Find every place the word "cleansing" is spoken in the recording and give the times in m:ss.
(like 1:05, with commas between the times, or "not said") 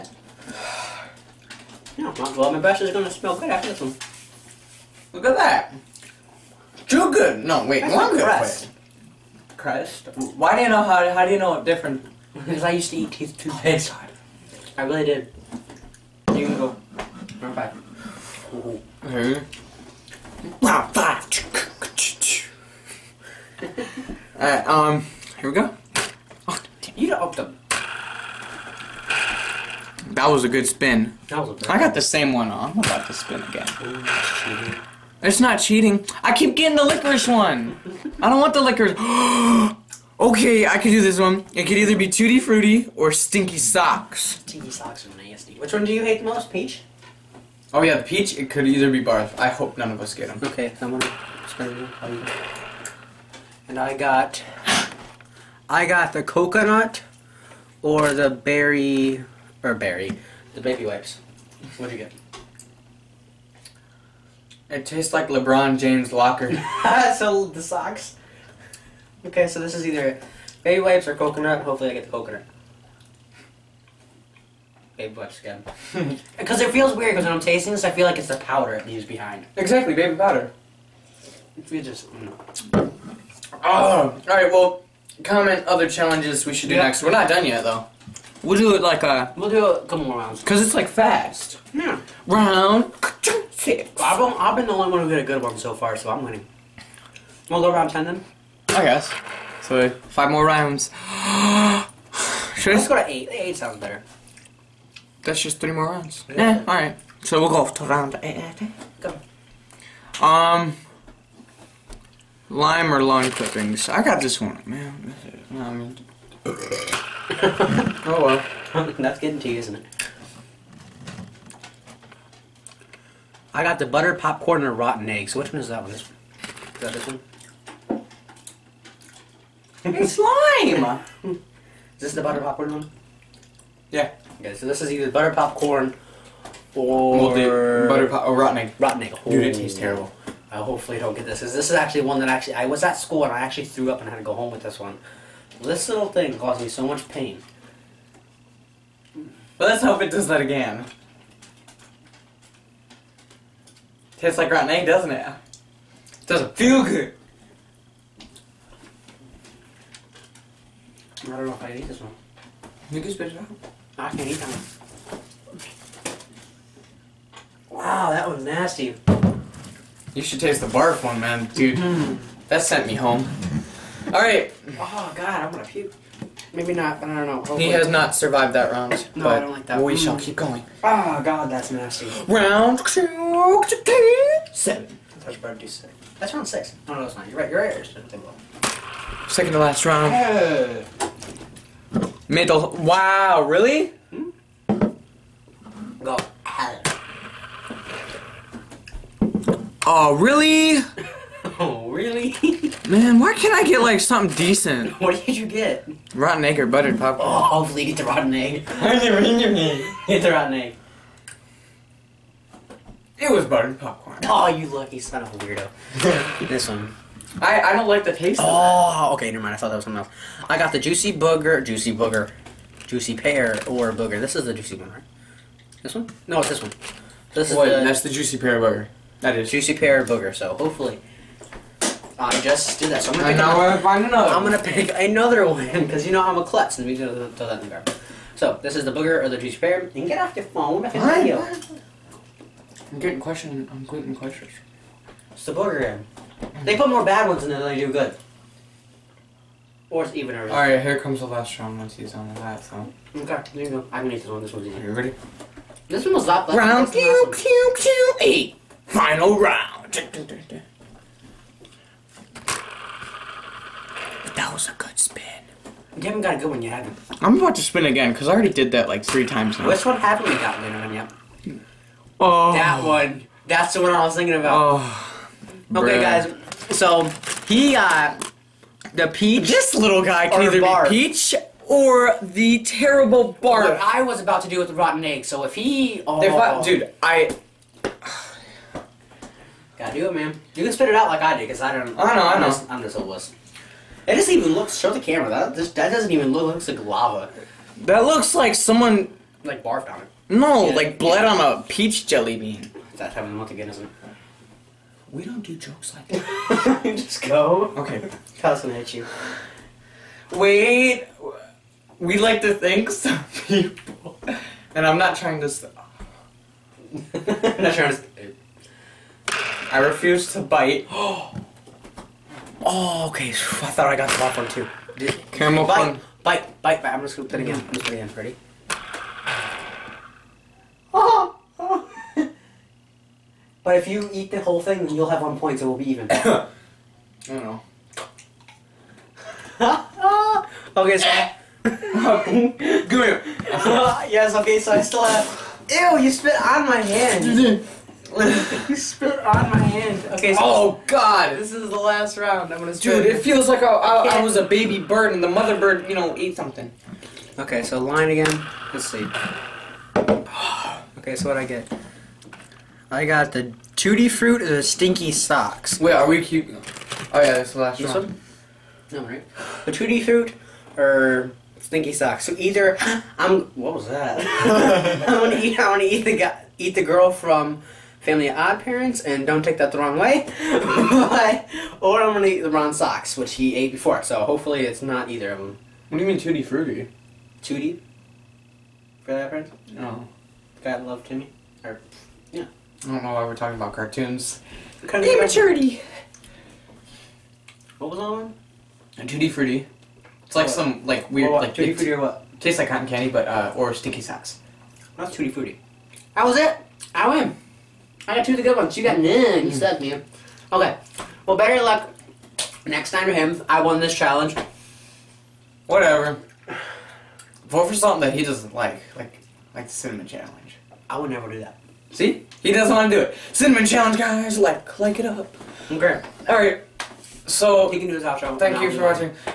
not said.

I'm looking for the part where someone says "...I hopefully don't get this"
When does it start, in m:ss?
2:20.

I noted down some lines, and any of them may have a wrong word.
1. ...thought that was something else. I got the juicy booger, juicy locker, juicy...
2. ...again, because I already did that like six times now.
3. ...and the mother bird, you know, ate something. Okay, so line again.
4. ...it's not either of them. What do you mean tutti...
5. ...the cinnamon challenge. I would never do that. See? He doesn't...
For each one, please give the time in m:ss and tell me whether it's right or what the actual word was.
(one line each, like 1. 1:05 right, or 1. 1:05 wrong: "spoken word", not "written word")
1. 3:39 wrong: "booger", not "locker"
2. 4:27 wrong: "three", not "six"
3. 5:55 right
4. 6:24 right
5. 6:59 right.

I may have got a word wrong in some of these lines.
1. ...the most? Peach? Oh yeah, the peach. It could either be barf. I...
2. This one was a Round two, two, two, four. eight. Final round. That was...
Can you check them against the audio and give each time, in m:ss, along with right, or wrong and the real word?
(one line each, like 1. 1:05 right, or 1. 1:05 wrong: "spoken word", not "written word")
1. 0:46 right
2. 4:15 wrong: "eight", not "four".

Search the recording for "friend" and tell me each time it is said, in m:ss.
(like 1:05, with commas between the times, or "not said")
6:29.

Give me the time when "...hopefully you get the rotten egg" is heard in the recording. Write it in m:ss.
3:27.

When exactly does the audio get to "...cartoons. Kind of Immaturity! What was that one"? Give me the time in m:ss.
6:33.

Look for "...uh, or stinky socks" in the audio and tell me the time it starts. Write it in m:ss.
6:43.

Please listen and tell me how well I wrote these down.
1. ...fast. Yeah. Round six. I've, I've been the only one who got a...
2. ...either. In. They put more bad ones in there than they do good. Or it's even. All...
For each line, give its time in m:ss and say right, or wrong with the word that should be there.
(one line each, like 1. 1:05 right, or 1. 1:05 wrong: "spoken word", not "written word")
1. 1:30 right
2. 4:05 wrong: "booger", not "either".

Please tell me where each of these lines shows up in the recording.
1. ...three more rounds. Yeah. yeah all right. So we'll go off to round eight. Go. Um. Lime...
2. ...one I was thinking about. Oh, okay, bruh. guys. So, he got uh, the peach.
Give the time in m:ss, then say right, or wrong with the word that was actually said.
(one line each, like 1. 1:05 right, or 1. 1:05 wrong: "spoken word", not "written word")
1. 1:45 right
2. 4:33 right.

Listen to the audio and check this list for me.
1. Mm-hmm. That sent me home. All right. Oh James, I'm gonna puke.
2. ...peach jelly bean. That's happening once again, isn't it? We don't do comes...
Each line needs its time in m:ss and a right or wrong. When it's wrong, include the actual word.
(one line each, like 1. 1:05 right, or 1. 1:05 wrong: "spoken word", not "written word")
1. 2:51 wrong: "God", not "James"
2. 5:01 wrong: "jokes", not "comes".